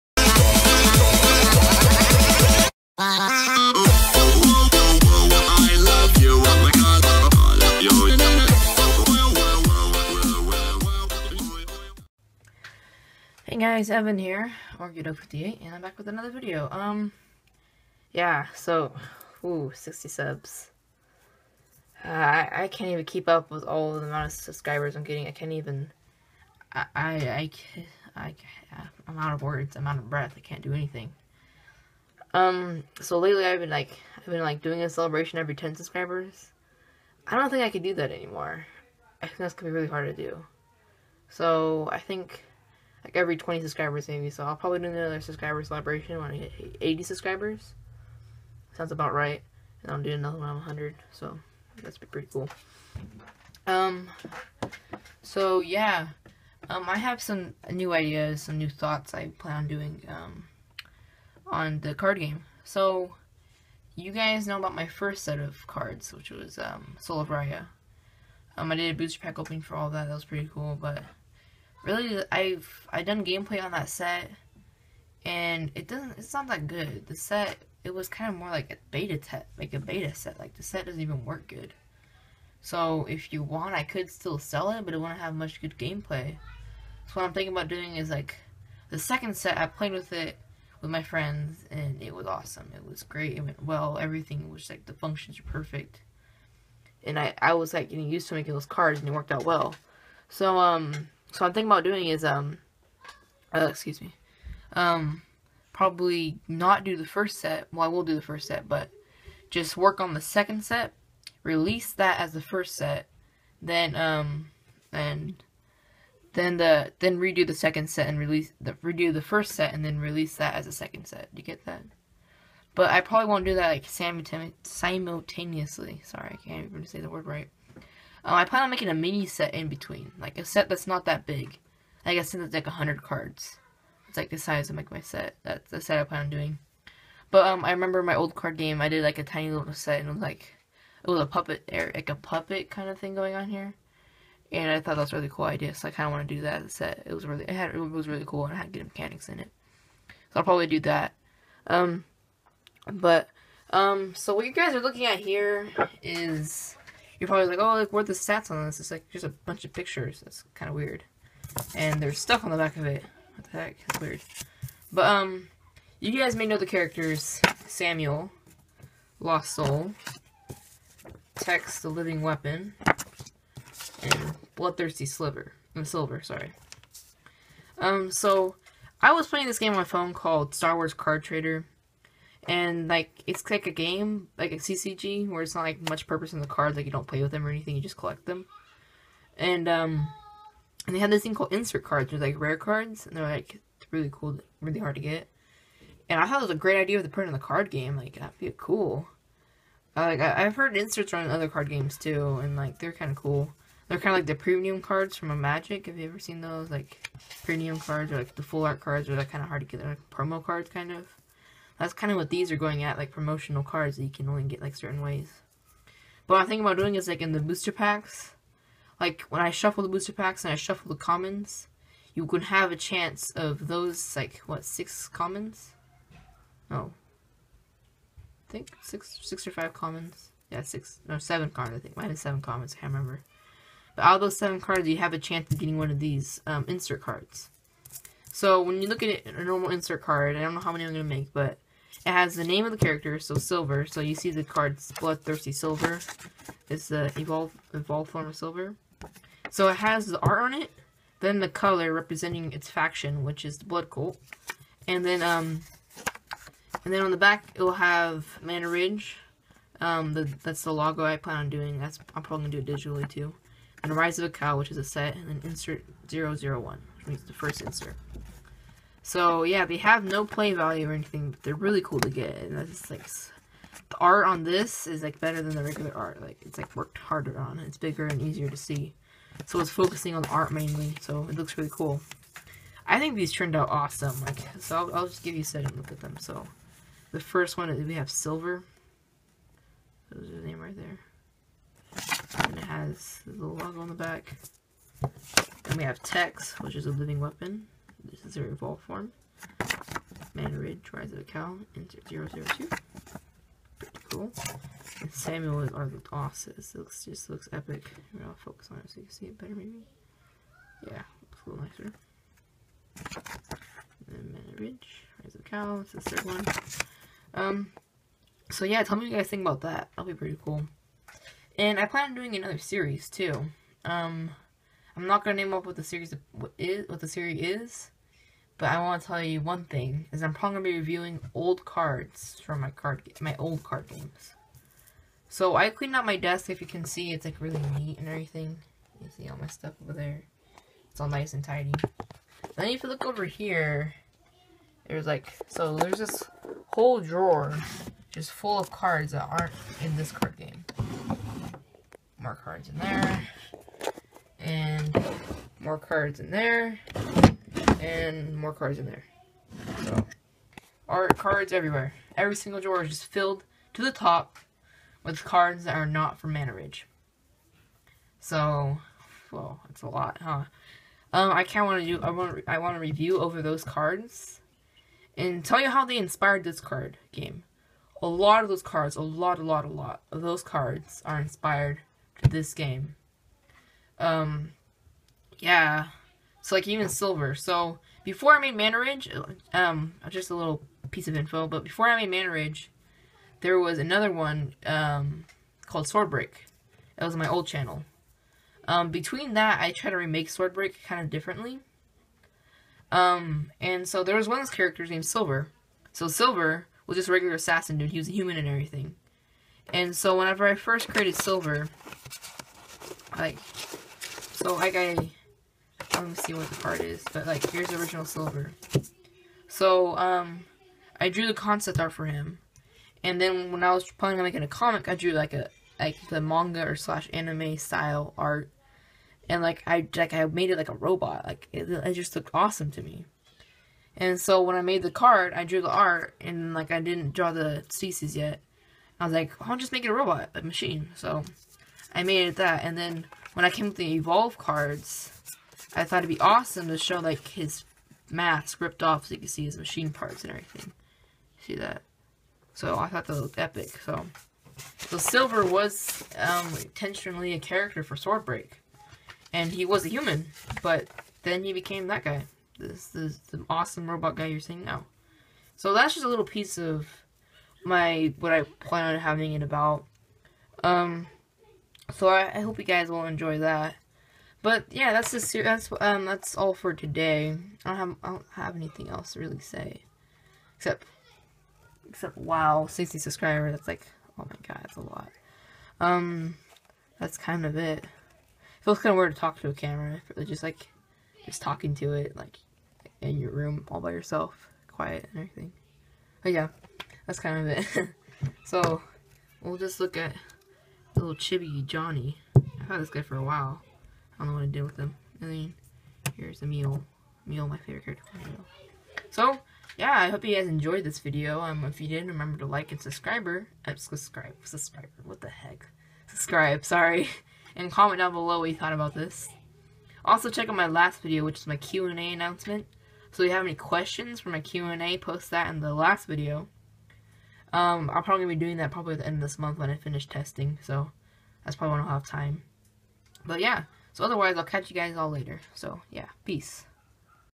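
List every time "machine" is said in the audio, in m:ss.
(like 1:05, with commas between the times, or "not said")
7:20, 7:29.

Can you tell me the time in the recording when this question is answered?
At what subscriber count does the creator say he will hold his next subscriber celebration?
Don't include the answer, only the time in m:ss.
0:46.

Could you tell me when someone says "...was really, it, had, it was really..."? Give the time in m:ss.
2:27.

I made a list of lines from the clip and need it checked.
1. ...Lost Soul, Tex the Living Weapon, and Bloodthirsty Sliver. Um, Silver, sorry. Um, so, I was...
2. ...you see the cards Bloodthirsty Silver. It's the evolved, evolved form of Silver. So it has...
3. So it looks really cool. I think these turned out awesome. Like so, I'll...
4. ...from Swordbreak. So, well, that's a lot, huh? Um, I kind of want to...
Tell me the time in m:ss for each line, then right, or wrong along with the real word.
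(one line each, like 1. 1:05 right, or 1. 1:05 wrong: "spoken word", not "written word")
1. 2:49 right
2. 4:04 right
3. 4:41 right
4. 6:06 wrong: "Manaridge", not "Swordbreak".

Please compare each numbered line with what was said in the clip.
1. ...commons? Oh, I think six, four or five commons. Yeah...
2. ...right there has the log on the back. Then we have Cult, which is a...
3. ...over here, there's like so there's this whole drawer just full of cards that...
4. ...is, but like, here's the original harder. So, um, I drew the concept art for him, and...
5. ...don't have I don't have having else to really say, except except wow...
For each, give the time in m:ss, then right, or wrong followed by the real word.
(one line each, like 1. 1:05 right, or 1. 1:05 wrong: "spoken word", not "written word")
1. 3:45 wrong: "six", not "four"
2. 4:50 wrong: "Tex", not "Cult"
3. 5:43 right
4. 6:56 wrong: "silver", not "harder"
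5. 7:57 wrong: "anything", not "having".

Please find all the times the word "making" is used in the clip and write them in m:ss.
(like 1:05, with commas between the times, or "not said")
1:38, 2:08, 7:04.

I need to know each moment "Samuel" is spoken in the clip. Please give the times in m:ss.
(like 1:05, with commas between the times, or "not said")
2:47, 5:05.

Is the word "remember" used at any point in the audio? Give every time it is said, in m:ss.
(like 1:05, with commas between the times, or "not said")
2:17, 3:52, 8:32.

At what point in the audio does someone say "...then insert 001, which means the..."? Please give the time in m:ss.
4:25.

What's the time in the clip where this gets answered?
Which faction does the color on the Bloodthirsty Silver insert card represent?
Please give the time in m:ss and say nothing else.
4:13.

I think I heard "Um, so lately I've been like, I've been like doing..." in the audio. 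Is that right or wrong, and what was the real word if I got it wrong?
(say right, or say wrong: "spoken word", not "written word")
right.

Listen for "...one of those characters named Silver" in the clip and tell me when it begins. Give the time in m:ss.
6:44.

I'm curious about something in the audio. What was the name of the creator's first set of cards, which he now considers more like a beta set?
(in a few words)
Soul of Raya.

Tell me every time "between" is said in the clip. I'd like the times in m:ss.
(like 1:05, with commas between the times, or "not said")
2:09, 6:38.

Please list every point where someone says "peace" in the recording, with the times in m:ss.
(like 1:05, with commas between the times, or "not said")
8:56.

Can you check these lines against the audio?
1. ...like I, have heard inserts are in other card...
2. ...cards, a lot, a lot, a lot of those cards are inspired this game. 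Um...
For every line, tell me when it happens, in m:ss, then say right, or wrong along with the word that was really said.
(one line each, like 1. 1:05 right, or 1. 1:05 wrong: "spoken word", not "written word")
1. 3:20 right
2. 6:18 right.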